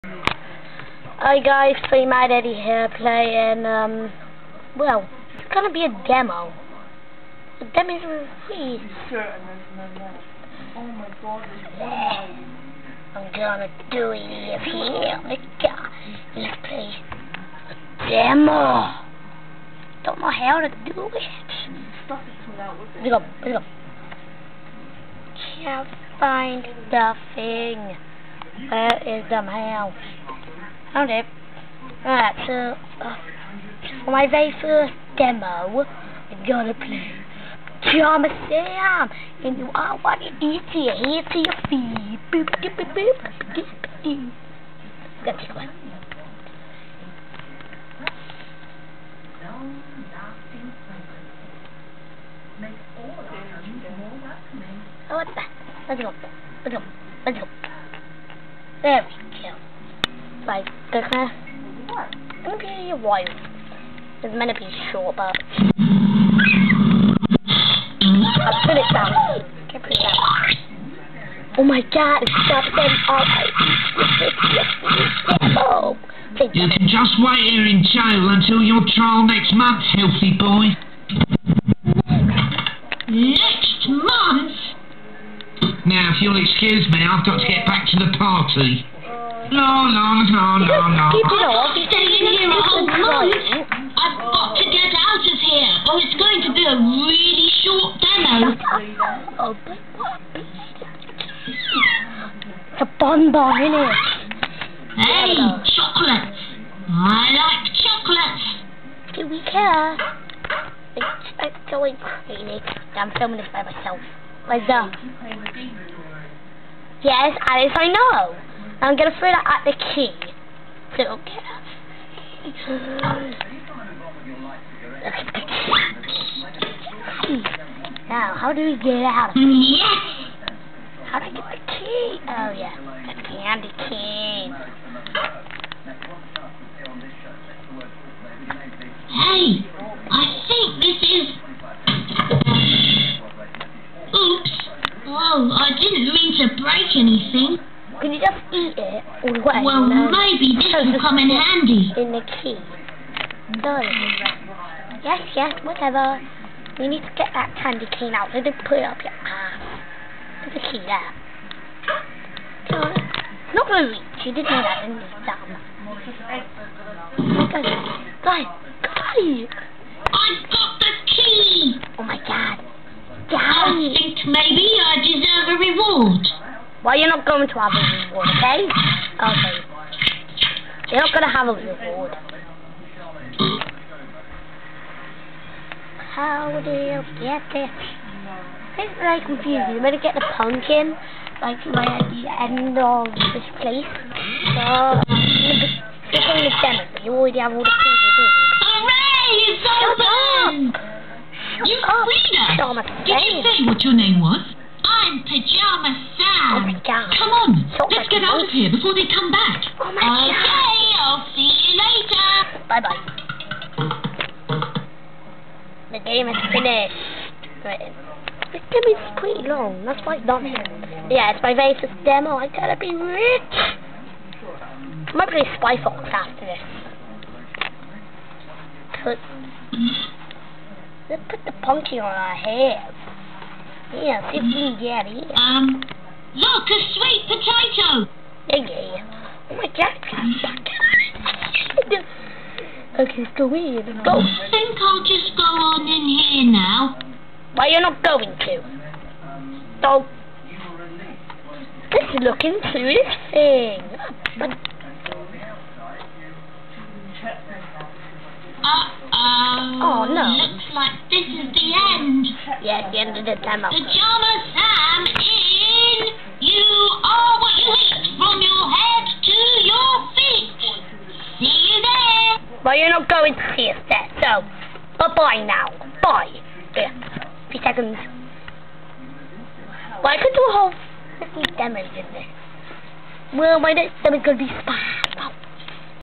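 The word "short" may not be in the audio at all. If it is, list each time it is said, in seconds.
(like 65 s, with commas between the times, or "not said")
64 s, 97 s.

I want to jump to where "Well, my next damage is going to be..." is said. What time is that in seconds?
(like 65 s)
283 s.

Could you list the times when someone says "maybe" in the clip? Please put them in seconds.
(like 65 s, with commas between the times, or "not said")
150 s, 174 s.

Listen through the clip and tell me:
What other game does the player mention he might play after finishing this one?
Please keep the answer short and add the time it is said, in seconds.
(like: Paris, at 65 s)
Spy Fox, at 225 s.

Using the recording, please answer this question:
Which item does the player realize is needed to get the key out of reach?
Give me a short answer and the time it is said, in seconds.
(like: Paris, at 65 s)
the candy cane, at 133 s.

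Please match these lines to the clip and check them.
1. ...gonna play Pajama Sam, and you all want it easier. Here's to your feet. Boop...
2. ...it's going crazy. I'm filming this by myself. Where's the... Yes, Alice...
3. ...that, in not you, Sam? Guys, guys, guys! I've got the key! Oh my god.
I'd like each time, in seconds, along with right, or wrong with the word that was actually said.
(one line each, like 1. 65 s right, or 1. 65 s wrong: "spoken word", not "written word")
1. 36 s right
2. 111 s right
3. 164 s right.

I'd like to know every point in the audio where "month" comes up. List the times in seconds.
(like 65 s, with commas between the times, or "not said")
79 s, 83 s, 92 s.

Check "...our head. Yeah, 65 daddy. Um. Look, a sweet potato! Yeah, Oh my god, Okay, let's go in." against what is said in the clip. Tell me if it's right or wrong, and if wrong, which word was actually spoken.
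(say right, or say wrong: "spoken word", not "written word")
wrong: "15", not "65".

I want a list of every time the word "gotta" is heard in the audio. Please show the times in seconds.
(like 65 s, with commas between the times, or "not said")
222 s.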